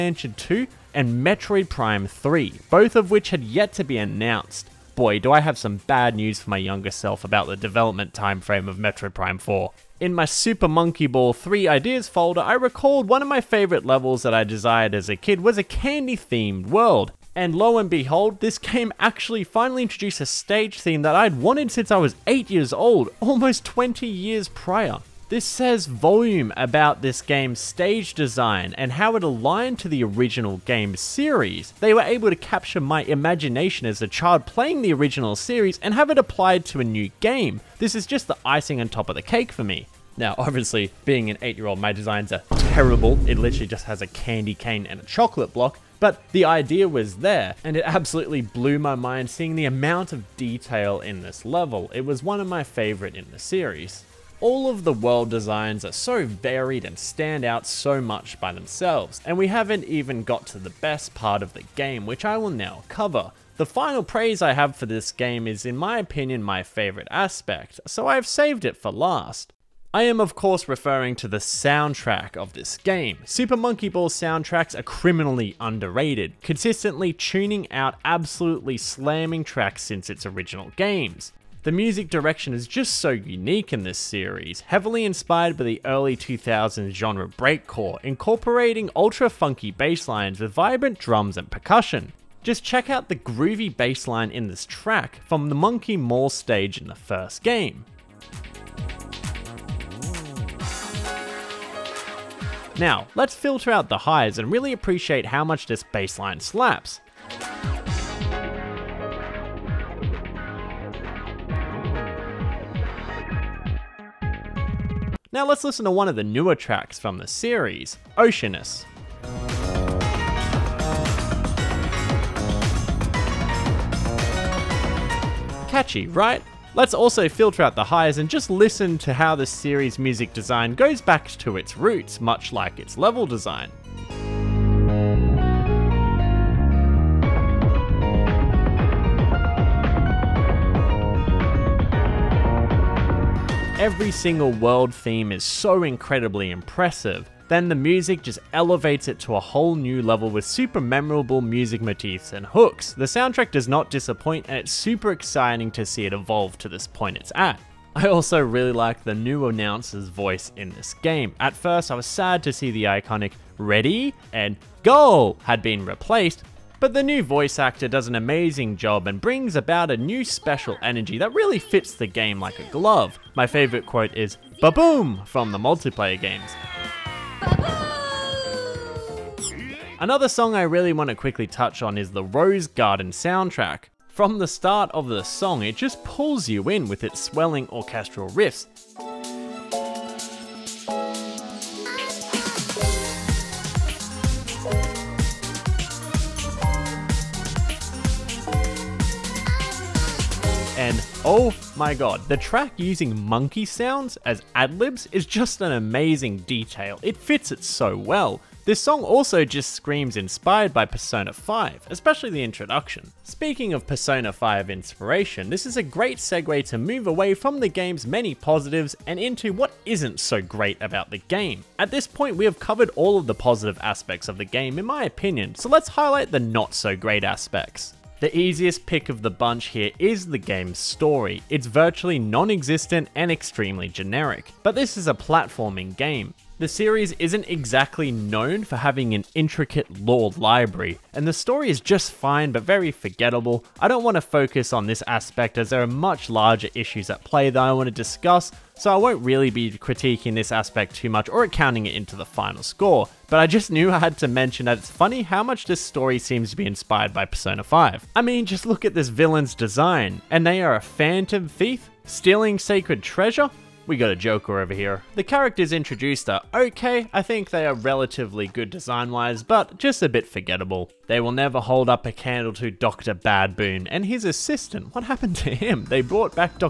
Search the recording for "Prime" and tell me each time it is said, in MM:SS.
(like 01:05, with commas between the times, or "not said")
00:01, 00:09.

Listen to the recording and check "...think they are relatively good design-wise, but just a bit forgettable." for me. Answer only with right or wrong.
right.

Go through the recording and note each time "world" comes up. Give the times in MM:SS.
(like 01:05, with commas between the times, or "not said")
00:16, 00:54, 02:24.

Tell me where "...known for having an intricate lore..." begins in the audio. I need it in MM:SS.
03:58.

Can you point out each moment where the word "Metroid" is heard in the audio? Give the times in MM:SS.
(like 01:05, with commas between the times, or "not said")
00:01, 00:08.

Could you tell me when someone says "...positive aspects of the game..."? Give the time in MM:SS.
03:43.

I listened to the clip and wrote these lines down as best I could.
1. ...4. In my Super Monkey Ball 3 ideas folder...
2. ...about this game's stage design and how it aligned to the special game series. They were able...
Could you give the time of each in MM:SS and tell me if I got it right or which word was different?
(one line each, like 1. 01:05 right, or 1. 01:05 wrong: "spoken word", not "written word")
1. 00:09 right
2. 00:26 wrong: "original", not "special".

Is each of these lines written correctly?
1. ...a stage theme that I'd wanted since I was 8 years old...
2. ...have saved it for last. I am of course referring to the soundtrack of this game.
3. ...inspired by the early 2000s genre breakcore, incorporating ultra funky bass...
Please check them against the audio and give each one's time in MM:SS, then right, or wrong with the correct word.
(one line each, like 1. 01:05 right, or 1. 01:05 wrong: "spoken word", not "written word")
1. 00:20 right
2. 01:08 right
3. 01:25 right.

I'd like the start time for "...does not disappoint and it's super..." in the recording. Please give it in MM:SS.
02:33.